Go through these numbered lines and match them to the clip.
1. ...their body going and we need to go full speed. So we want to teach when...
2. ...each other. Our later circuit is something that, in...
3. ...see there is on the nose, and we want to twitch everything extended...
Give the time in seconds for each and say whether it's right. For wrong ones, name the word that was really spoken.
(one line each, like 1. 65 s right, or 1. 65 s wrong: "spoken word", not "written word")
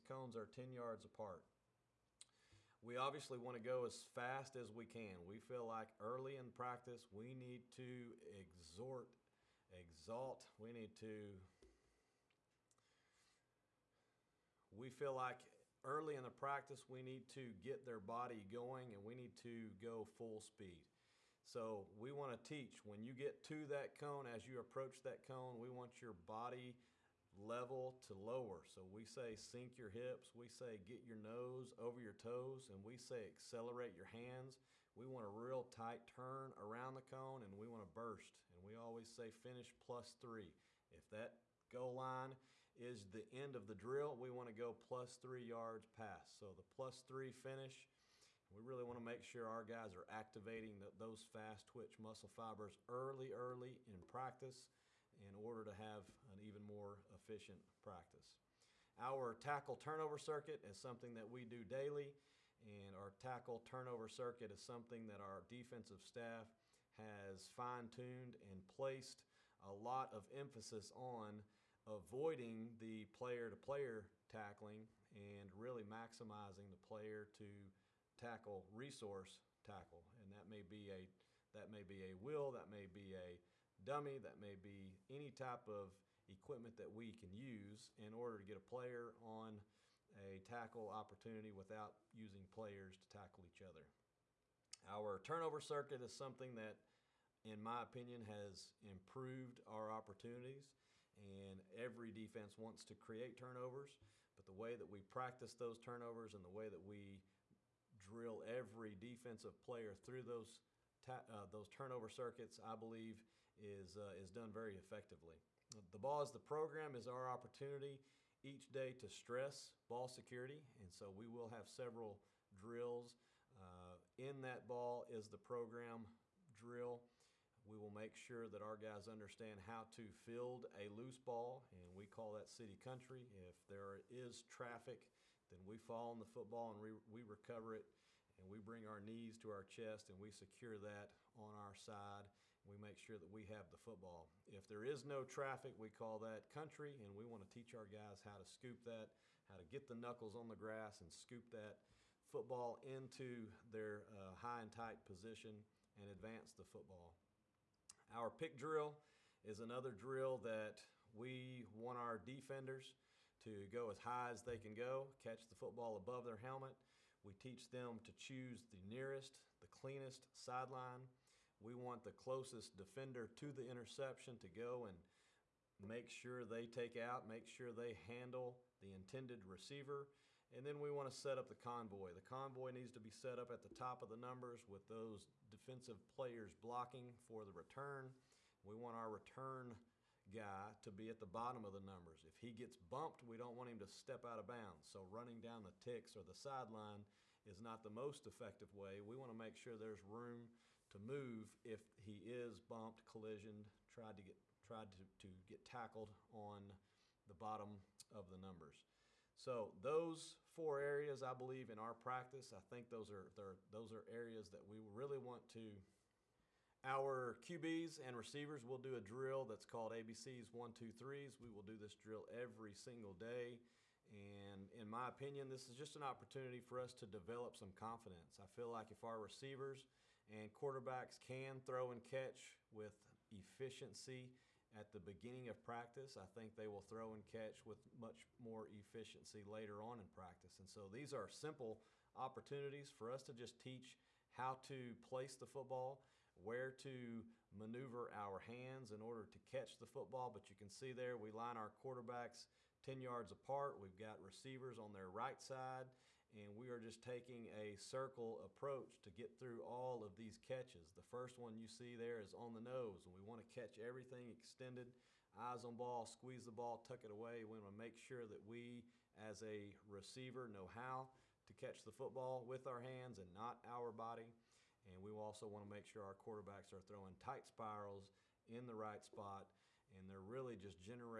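1. 17 s right
2. 93 s wrong: "turnover", not "later"
3. 261 s wrong: "catch", not "twitch".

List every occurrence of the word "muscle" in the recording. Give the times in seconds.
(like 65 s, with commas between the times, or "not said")
51 s.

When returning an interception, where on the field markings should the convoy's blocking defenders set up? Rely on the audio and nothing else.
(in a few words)
Top of the numbers.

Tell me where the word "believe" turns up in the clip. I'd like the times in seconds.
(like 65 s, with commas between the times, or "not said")
112 s, 211 s.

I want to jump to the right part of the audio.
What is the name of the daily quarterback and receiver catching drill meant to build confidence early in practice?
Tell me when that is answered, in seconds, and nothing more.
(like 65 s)
219 s.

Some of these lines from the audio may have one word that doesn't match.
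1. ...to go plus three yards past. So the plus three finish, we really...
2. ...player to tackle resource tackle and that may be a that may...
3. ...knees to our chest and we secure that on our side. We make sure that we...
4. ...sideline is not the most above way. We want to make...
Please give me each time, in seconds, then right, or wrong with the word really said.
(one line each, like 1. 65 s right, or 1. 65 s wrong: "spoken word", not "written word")
1. 44 s right
2. 76 s right
3. 138 s right
4. 196 s wrong: "effective", not "above".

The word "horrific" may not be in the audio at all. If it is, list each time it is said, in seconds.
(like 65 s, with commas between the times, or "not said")
not said.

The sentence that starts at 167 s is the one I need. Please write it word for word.
We teach them to choose the nearest, the cleanest sideline.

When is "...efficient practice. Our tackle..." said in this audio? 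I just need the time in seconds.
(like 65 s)
57 s.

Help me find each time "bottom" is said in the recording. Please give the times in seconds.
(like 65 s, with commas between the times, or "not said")
191 s, 207 s.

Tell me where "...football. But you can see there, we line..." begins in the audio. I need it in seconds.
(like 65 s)
249 s.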